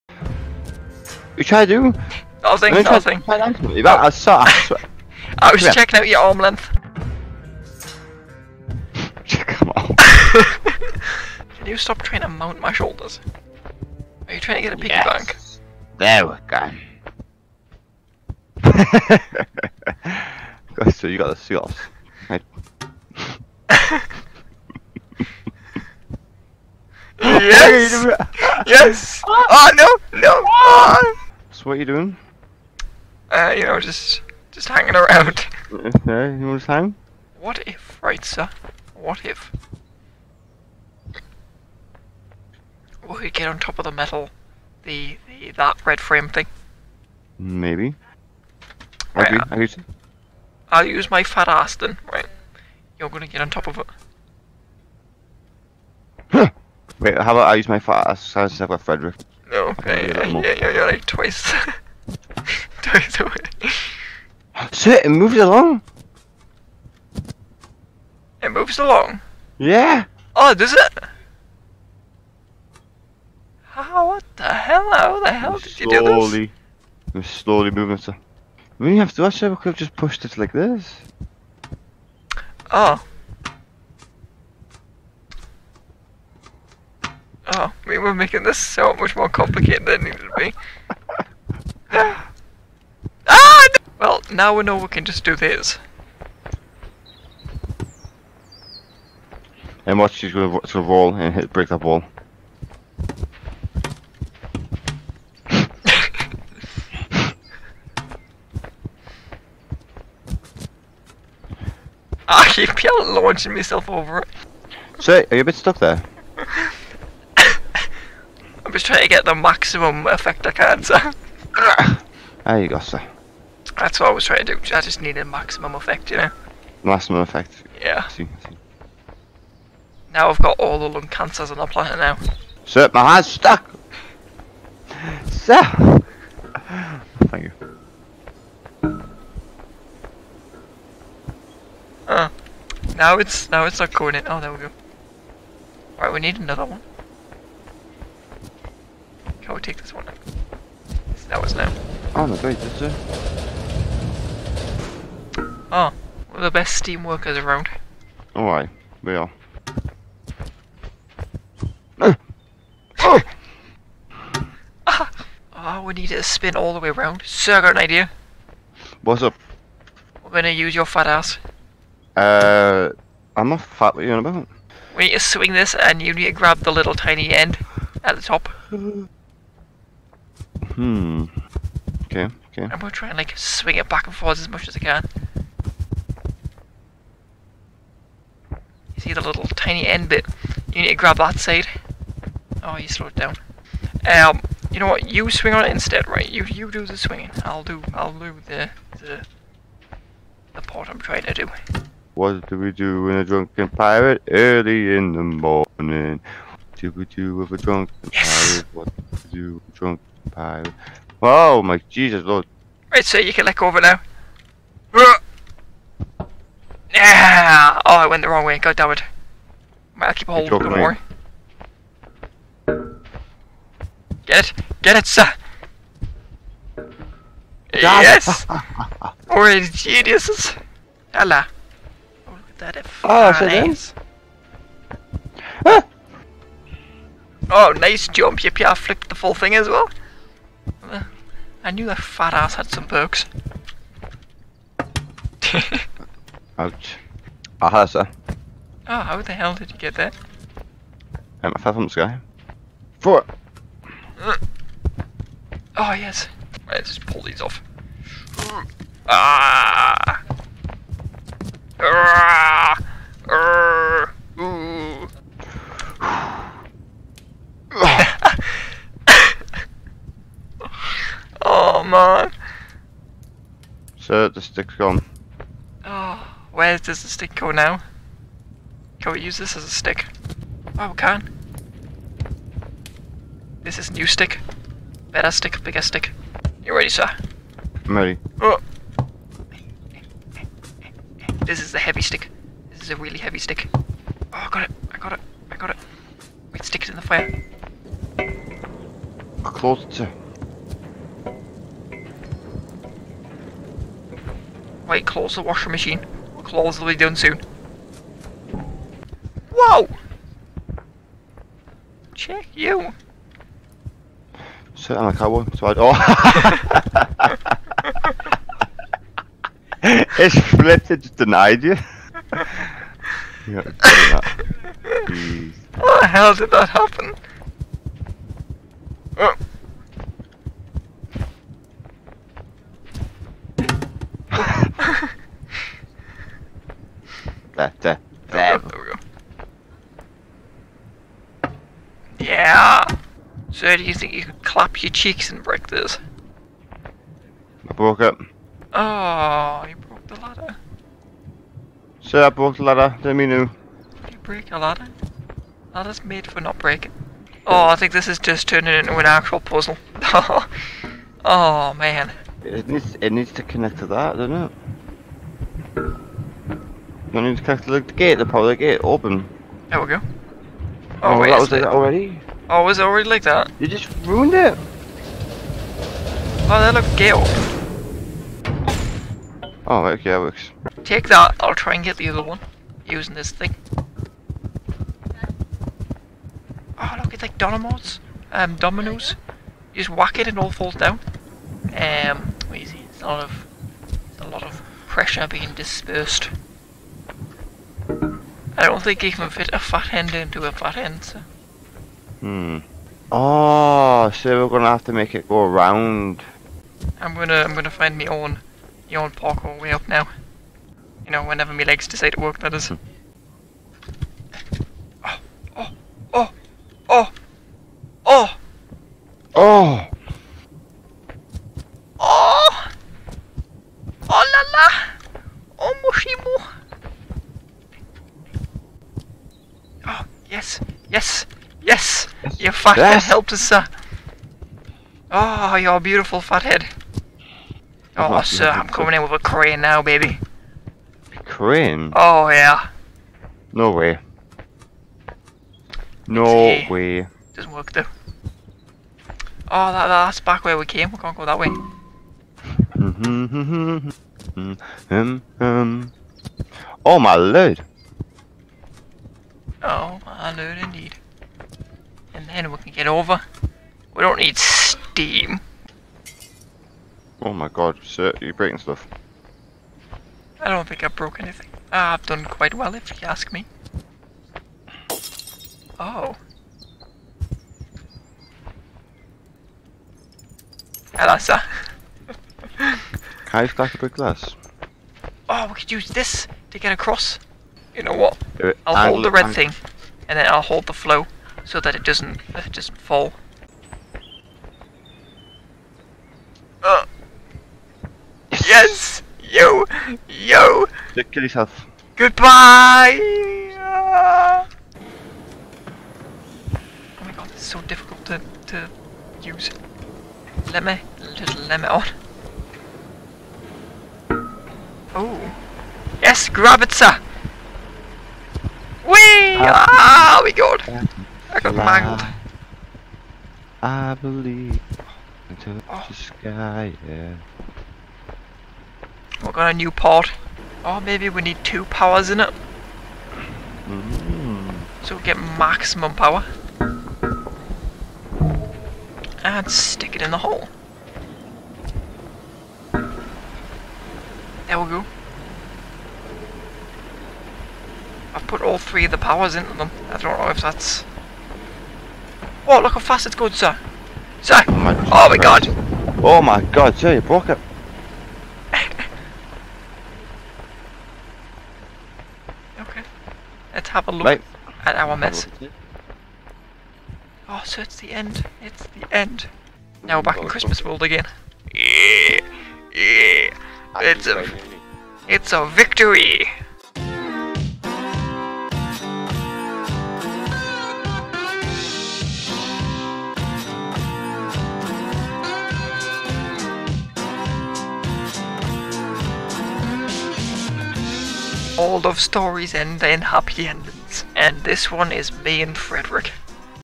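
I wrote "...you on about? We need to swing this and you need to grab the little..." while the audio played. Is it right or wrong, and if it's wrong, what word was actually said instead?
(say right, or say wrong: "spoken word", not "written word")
right.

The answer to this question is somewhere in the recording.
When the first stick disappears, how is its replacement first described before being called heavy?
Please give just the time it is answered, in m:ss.
4:45.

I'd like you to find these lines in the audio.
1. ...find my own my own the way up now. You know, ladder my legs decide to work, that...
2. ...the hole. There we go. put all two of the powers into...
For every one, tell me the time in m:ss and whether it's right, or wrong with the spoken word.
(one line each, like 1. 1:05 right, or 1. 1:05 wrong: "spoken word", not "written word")
1. 6:47 wrong: "whenever", not "ladder"
2. 9:00 wrong: "three", not "two".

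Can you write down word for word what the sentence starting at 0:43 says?
we get on top of the metal, the, the that red frame thing?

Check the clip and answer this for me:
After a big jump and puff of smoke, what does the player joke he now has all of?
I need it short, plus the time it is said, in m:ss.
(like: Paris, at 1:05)
Lung cancers, at 2:10.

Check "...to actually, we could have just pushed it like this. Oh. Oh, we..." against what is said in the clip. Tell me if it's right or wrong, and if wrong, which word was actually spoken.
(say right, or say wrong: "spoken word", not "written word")
right.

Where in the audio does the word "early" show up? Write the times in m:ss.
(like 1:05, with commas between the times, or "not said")
3:24.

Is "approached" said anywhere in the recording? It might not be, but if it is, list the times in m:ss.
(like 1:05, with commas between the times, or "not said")
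not said.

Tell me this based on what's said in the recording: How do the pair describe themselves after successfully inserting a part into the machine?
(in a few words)
The best steam workers.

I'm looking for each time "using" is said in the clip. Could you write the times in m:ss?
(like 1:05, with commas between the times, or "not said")
6:22.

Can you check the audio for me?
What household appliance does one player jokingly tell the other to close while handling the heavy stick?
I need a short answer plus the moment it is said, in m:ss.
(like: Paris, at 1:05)
Washing machine, at 5:05.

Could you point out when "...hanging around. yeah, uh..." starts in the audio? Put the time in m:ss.
0:34.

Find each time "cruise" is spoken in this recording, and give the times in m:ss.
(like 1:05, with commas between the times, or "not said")
not said.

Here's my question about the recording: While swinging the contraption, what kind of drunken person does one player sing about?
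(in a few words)
A drunken pirate.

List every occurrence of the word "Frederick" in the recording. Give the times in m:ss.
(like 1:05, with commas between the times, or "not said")
0:58, 9:55.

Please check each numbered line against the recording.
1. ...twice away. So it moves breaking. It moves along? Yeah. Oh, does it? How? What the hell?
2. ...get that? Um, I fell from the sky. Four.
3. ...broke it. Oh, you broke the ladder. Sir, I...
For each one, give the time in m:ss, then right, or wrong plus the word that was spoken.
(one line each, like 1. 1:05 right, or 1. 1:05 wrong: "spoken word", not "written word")
1. 1:02 wrong: "along", not "breaking"
2. 4:09 right
3. 5:47 right.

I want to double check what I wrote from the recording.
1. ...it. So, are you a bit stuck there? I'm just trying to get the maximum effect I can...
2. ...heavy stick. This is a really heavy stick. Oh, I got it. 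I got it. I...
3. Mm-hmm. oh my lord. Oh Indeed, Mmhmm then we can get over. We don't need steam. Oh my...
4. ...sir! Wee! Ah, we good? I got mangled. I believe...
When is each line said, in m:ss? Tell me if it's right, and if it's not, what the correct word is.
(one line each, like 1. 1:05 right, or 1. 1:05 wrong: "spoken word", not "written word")
1. 1:54 right
2. 4:51 right
3. 7:34 wrong: "And", not "Mmhmm"
4. 8:36 right.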